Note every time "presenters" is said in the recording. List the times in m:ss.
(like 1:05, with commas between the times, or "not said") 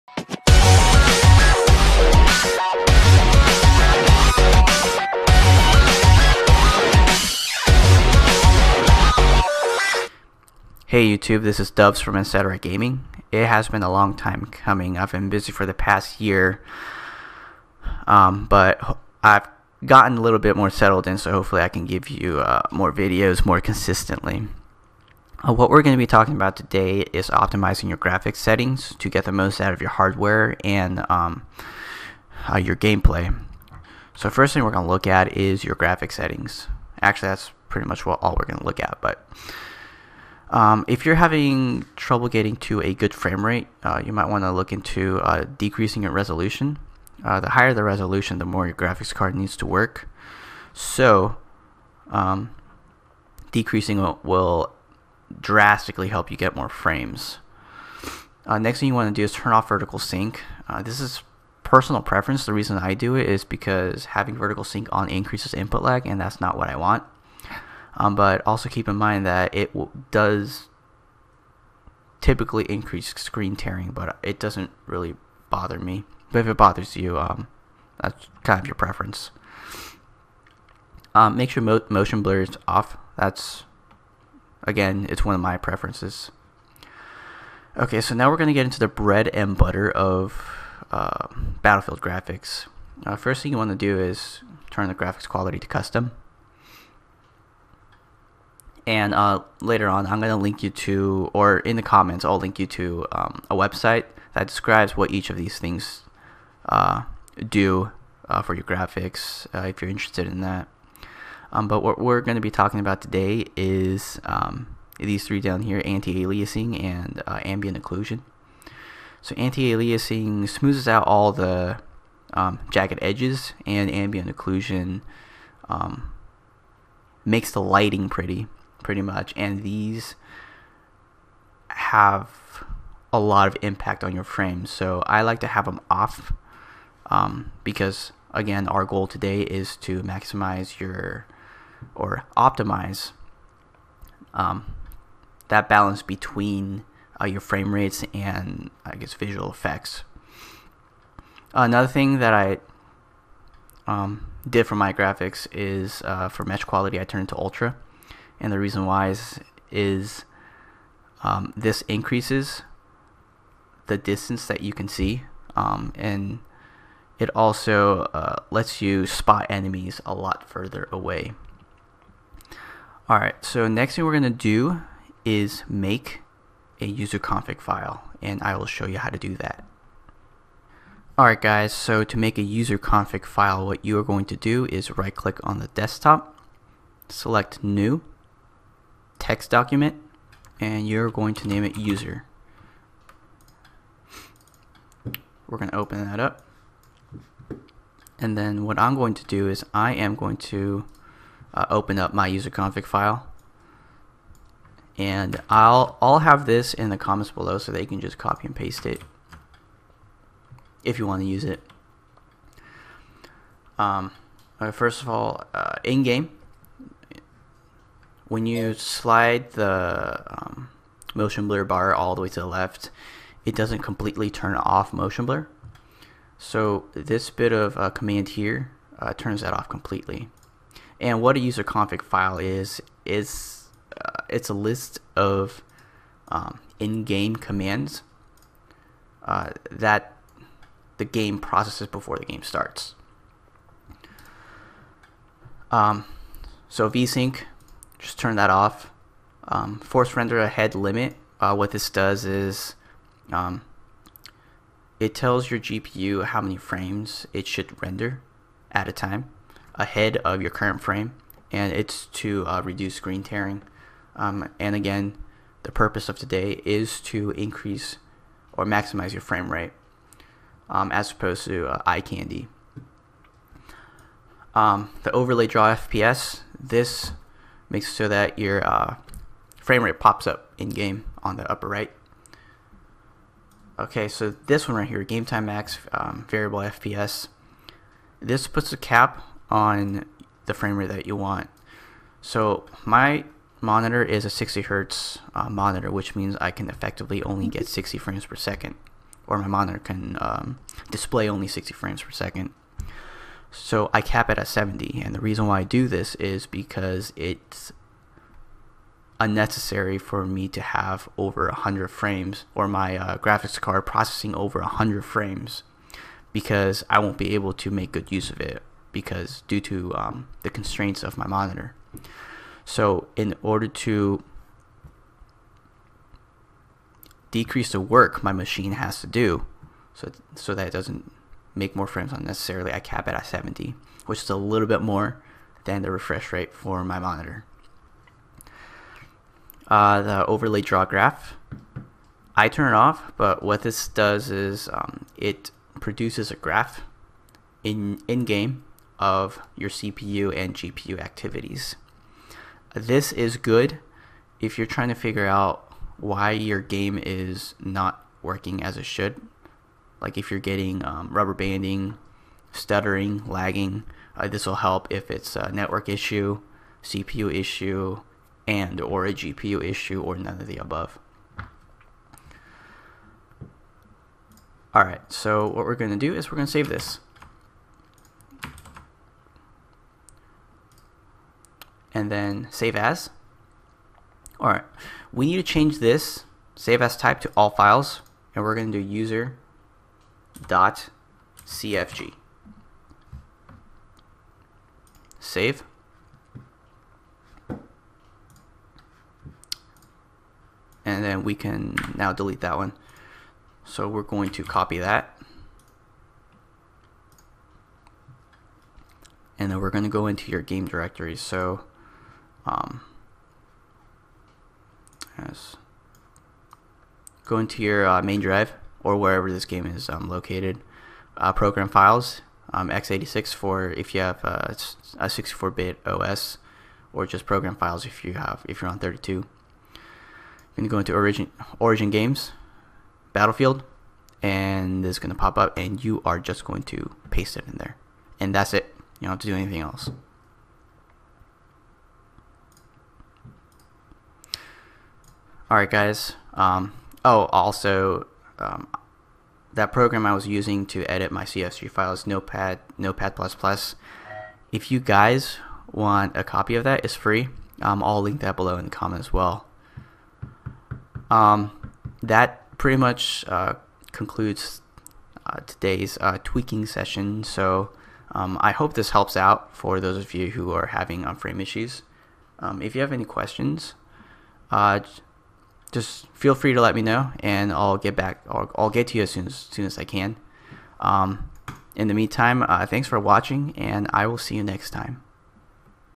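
not said.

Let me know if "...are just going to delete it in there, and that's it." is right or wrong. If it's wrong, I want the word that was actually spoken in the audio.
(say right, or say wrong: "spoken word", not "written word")
wrong: "paste", not "delete".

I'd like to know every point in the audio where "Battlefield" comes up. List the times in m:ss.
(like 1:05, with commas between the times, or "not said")
1:31, 7:13.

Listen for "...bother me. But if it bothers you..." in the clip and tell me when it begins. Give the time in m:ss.
1:15.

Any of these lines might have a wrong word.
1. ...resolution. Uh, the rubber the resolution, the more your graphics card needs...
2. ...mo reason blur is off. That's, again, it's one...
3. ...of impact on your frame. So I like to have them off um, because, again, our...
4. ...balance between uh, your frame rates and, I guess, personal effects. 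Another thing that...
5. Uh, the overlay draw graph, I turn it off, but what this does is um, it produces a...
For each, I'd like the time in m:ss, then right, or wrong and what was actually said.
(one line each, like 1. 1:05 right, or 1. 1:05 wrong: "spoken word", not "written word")
1. 0:46 wrong: "higher", not "rubber"
2. 1:21 wrong: "motion", not "reason"
3. 2:13 right
4. 2:25 wrong: "visual", not "personal"
5. 5:39 right.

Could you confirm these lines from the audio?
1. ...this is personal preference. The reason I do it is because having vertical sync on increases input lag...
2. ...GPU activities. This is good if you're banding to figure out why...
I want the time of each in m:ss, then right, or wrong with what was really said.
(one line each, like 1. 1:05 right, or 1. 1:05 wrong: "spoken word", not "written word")
1. 1:00 right
2. 5:50 wrong: "trying", not "banding".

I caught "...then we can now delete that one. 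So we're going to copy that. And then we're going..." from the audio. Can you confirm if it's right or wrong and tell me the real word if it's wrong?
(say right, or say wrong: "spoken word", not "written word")
right.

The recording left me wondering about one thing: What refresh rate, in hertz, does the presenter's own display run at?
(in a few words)
60.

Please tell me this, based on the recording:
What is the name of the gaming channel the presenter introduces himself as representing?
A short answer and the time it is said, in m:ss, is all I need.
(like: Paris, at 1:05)
Etc. Gaming, at 0:12.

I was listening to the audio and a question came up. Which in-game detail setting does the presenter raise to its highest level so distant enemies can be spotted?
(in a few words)
mesh quality.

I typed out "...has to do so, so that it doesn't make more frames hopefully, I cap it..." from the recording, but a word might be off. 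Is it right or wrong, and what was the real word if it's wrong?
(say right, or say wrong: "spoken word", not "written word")
wrong: "unnecessarily", not "hopefully".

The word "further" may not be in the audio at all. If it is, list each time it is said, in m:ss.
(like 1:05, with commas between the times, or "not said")
2:50.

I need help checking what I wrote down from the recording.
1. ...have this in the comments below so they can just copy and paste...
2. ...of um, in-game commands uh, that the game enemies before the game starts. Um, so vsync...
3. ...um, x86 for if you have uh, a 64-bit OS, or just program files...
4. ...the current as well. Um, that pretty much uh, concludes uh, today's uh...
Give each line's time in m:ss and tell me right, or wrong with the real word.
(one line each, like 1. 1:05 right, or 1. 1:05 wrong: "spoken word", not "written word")
1. 3:26 right
2. 3:55 wrong: "processes", not "enemies"
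3. 7:02 right
4. 7:38 wrong: "comment", not "current".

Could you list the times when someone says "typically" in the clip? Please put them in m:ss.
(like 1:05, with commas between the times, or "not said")
1:12.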